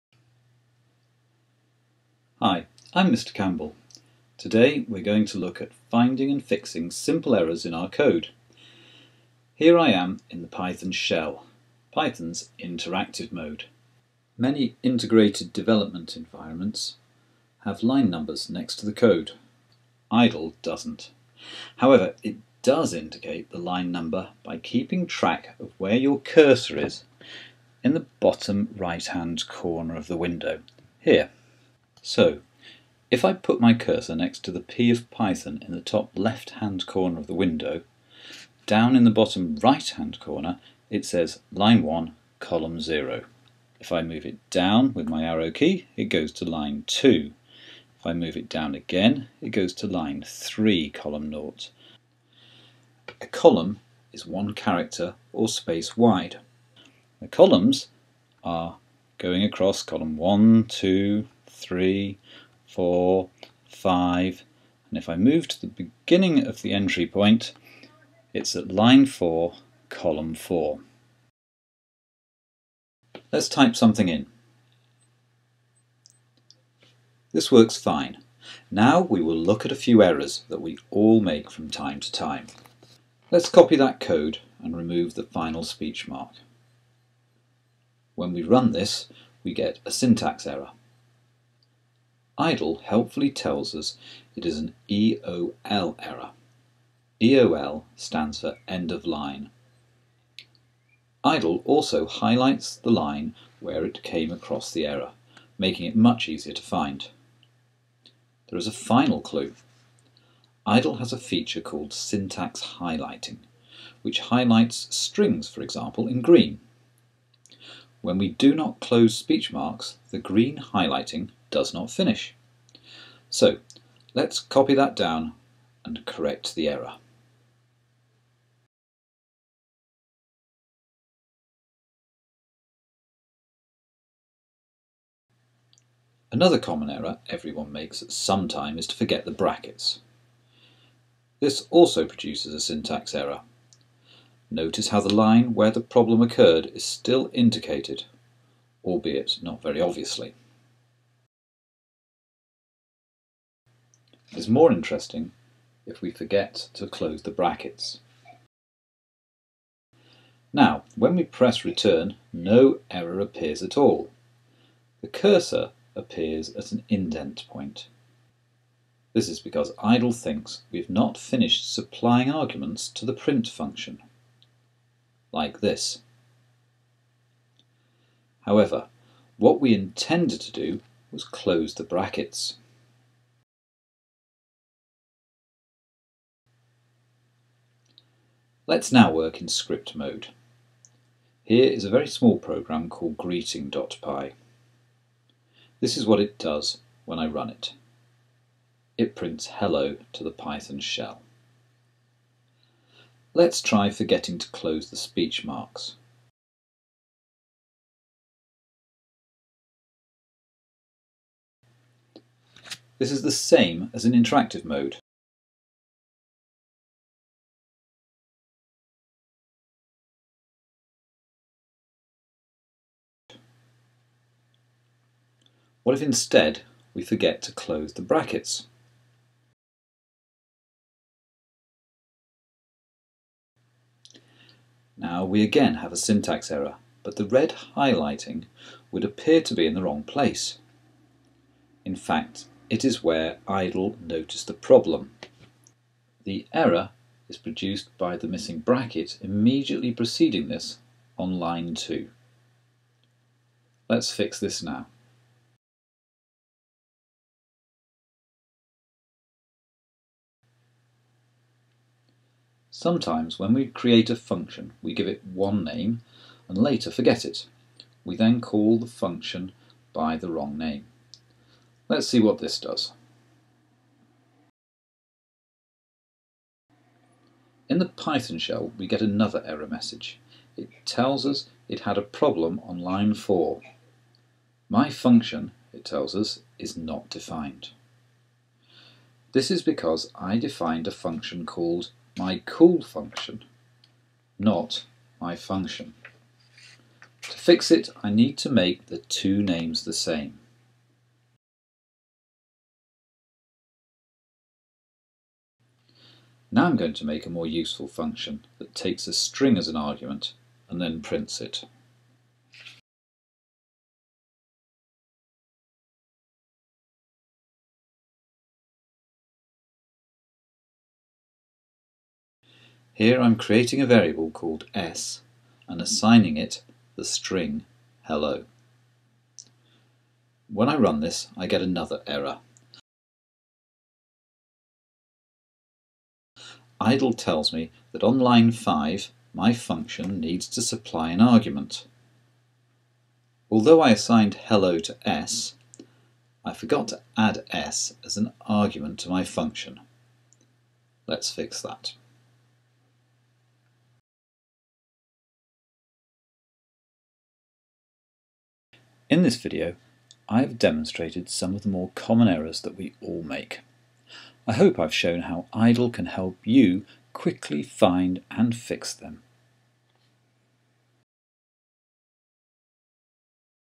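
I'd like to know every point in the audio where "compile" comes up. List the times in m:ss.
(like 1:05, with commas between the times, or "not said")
not said.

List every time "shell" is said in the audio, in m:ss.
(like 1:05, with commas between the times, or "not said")
0:10, 3:20, 4:38.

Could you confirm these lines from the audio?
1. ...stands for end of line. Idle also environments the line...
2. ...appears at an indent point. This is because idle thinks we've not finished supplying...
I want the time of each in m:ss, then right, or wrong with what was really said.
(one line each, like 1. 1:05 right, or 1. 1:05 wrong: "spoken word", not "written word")
1. 1:37 wrong: "highlights", not "environments"
2. 2:45 right.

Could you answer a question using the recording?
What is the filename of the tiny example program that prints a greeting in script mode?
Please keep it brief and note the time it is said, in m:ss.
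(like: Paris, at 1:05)
greeting.py, at 3:13.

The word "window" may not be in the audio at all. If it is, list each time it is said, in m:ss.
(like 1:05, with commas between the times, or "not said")
0:30, 0:37.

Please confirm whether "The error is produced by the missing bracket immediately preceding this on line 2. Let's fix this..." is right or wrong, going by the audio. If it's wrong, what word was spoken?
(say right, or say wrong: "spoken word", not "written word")
right.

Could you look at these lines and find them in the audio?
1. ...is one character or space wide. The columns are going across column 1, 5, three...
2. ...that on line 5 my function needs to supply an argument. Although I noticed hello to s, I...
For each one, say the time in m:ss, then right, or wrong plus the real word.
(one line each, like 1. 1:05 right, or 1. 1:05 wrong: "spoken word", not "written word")
1. 0:54 wrong: "2", not "5"
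2. 5:37 wrong: "assigned", not "noticed".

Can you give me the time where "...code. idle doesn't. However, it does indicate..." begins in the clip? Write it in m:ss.
0:18.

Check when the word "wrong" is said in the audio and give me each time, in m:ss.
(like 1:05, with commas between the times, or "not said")
3:59, 4:30.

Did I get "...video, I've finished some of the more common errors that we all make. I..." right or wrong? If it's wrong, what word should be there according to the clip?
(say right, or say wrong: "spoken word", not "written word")
wrong: "demonstrated", not "finished".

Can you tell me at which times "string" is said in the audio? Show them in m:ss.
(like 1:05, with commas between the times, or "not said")
1:54, 5:09, 5:27.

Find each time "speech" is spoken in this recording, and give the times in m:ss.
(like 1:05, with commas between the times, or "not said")
1:25, 1:59, 3:24.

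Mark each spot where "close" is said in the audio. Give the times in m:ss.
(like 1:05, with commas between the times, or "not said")
1:58, 2:36, 3:01, 3:24, 3:47.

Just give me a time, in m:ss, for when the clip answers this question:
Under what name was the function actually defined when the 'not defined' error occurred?
4:52.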